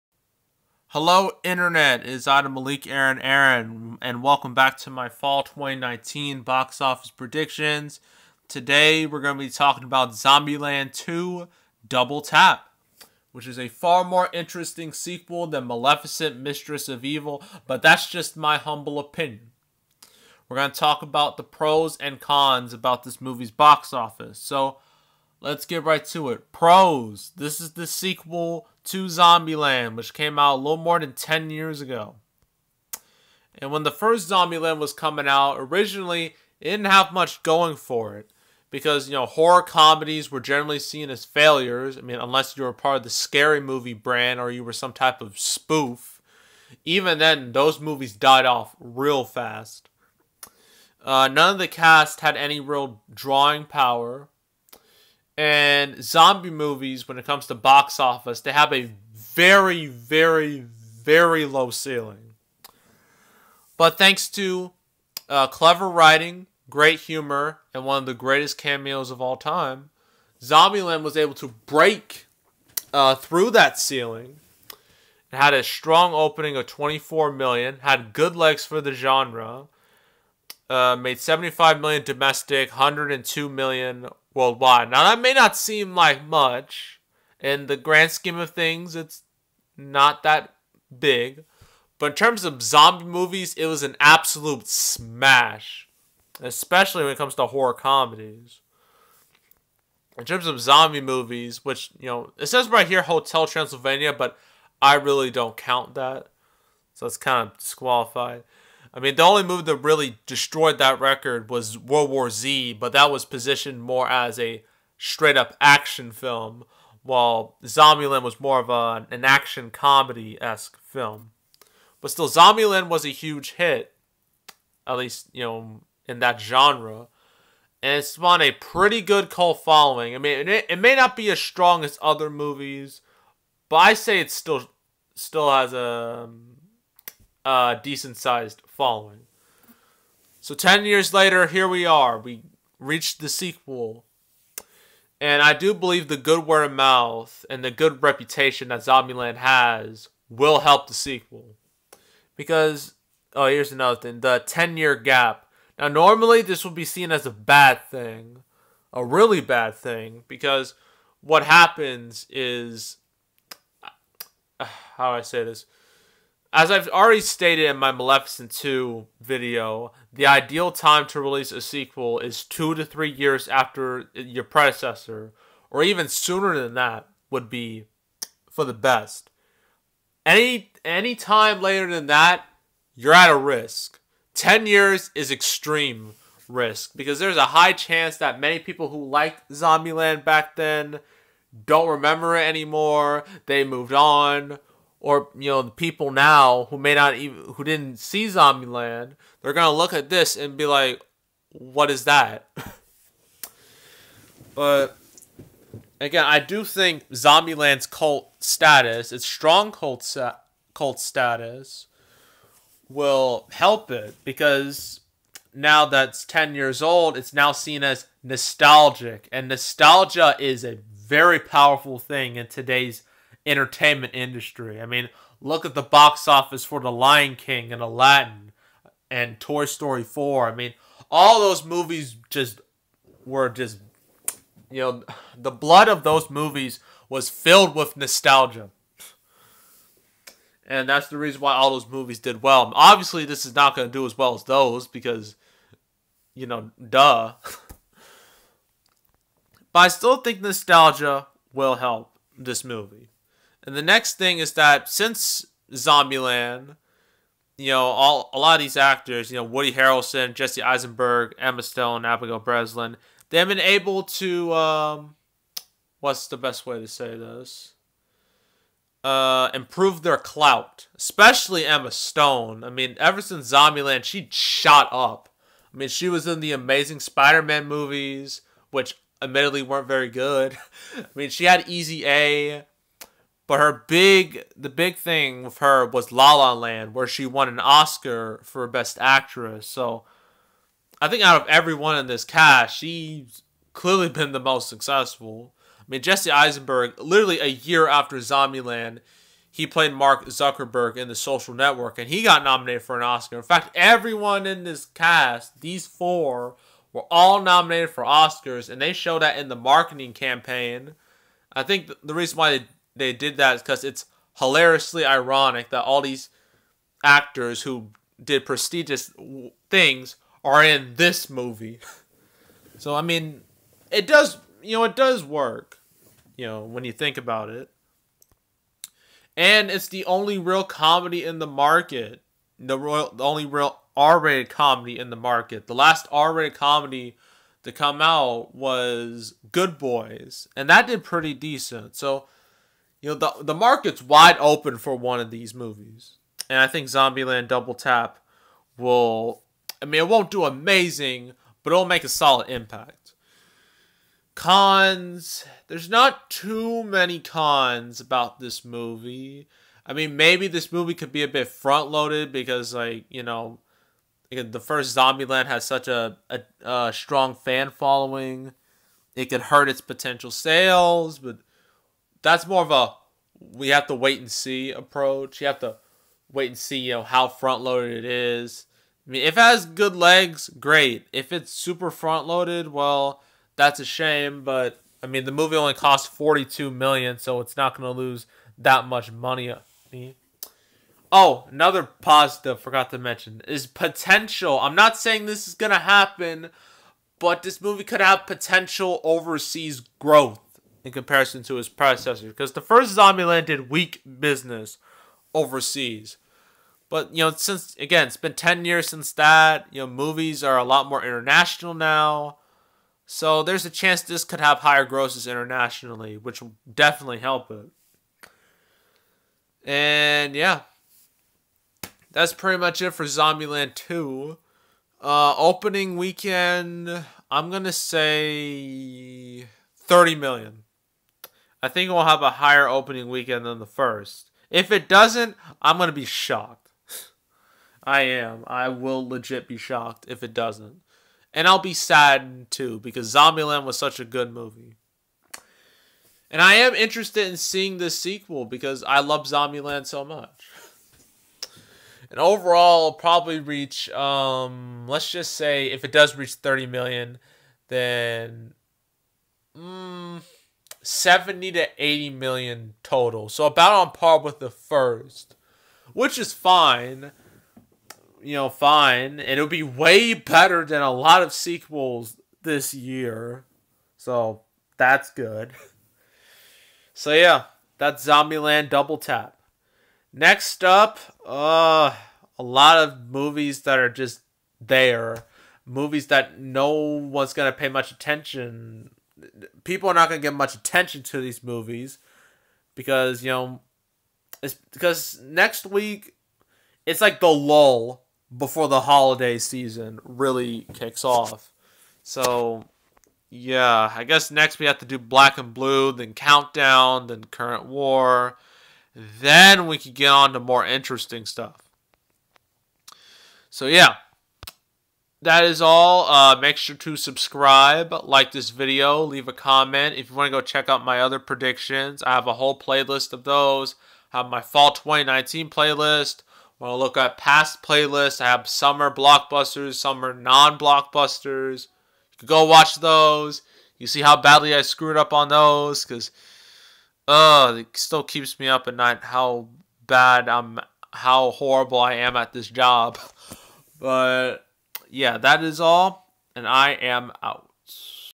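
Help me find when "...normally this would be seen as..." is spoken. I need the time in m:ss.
2:35.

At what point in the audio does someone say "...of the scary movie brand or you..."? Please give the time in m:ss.
0:42.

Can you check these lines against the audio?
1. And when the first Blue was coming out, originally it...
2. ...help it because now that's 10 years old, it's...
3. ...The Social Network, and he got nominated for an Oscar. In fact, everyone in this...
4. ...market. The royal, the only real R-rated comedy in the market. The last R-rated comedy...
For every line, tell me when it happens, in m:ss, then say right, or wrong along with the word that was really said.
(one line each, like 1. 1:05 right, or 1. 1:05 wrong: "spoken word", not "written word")
1. 0:33 wrong: "Zombieland", not "Blue"
2. 3:33 right
3. 5:01 right
4. 5:31 right.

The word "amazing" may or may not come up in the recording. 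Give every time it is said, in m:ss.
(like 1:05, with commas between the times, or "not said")
4:36, 5:50.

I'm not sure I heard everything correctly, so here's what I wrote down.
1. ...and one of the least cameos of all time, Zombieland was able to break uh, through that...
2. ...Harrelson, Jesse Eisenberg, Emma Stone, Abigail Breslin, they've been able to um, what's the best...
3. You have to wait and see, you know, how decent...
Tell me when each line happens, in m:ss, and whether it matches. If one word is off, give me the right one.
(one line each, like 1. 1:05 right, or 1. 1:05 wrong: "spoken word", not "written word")
1. 1:07 wrong: "greatest", not "least"
2. 4:19 right
3. 6:15 wrong: "front", not "decent".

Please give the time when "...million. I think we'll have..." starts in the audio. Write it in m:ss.
7:10.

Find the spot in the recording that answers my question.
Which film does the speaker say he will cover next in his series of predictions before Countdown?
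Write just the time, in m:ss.
8:24.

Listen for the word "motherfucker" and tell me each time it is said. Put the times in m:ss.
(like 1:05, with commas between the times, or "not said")
not said.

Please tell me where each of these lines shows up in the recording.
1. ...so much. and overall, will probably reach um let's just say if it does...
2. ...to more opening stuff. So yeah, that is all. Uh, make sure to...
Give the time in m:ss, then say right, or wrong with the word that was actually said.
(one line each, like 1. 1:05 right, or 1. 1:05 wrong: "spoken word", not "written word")
1. 7:29 right
2. 8:30 wrong: "interesting", not "opening".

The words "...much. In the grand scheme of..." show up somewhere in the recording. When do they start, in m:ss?
1:26.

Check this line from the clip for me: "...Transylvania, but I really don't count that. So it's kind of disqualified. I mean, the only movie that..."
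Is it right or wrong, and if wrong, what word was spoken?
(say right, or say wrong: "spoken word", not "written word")
right.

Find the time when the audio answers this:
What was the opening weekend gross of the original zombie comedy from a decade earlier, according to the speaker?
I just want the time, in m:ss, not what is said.
1:16.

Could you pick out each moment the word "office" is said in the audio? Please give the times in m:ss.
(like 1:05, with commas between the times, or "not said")
0:06, 0:23, 0:57, 3:46.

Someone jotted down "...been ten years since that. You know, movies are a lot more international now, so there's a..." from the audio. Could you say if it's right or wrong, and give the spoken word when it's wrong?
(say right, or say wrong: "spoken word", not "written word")
right.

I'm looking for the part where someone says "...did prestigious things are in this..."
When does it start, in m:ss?
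5:18.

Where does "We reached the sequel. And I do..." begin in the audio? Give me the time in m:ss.
2:22.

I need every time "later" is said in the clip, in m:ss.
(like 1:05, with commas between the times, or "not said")
2:21, 3:01.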